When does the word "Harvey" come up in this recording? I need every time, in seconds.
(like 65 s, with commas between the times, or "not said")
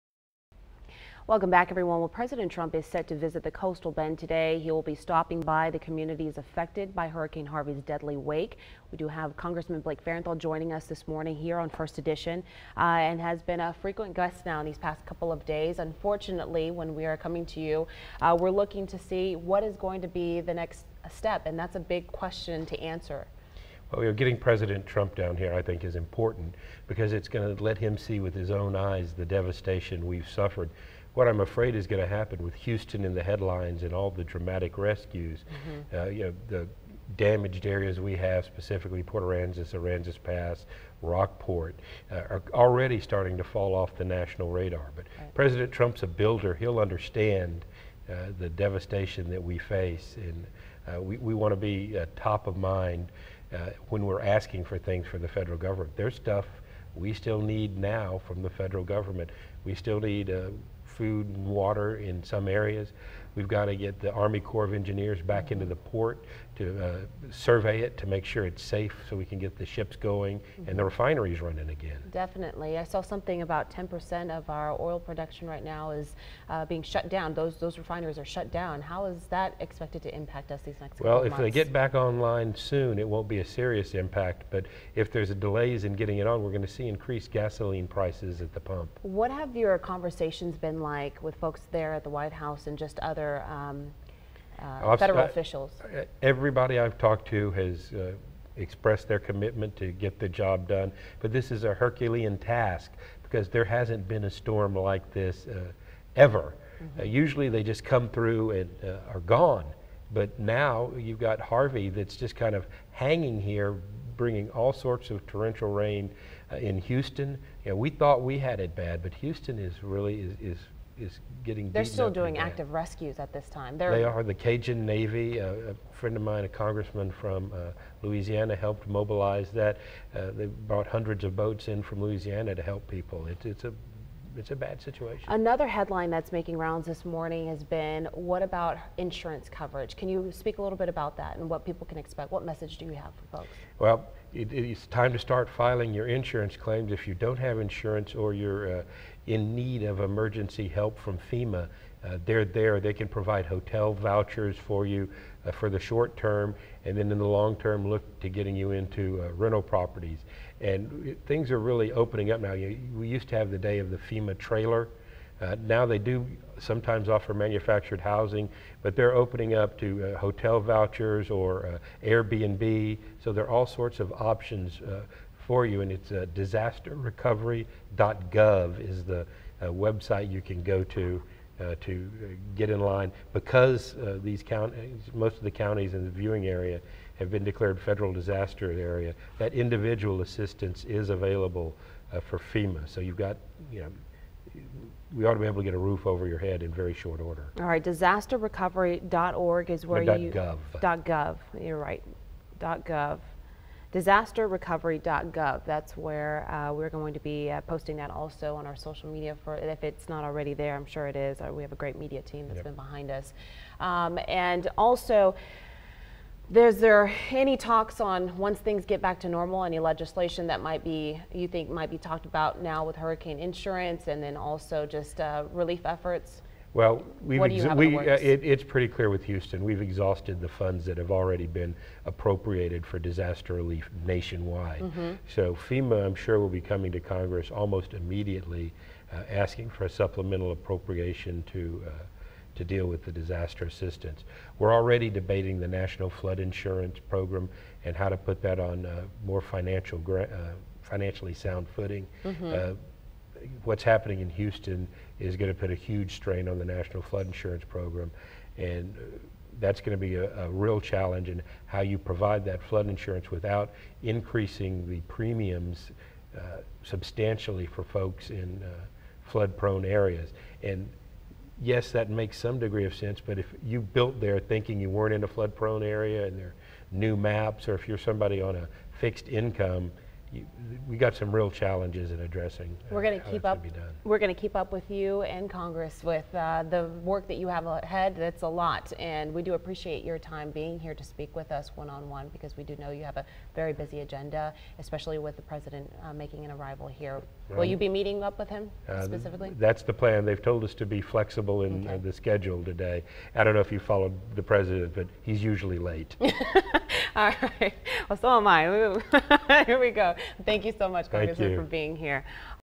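7 s, 111 s.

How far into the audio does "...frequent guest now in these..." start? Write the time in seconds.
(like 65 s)
13 s.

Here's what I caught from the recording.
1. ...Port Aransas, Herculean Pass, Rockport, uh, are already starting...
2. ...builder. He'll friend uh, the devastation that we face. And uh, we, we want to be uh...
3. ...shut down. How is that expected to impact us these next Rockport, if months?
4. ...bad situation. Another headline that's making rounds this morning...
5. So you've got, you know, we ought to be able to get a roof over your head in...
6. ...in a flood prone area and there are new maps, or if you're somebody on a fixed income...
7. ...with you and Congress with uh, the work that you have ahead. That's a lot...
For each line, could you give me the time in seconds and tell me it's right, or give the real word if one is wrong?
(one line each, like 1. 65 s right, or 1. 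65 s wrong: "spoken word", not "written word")
1. 39 s wrong: "Aransas", not "Herculean"
2. 46 s wrong: "understand", not "friend"
3. 78 s wrong: "Well", not "Rockport"
4. 134 s right
5. 192 s right
6. 275 s right
7. 284 s right.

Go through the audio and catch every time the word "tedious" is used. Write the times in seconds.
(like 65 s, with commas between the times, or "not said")
not said.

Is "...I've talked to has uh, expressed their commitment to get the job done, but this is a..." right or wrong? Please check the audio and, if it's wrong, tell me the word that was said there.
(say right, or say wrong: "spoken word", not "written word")
right.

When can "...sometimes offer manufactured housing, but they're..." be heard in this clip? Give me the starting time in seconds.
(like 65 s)
166 s.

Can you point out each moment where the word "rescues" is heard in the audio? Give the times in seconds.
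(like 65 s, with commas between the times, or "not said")
34 s, 122 s.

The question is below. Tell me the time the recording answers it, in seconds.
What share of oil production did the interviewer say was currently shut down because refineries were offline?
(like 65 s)
73 s.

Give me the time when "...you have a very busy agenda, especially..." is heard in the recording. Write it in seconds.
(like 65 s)
292 s.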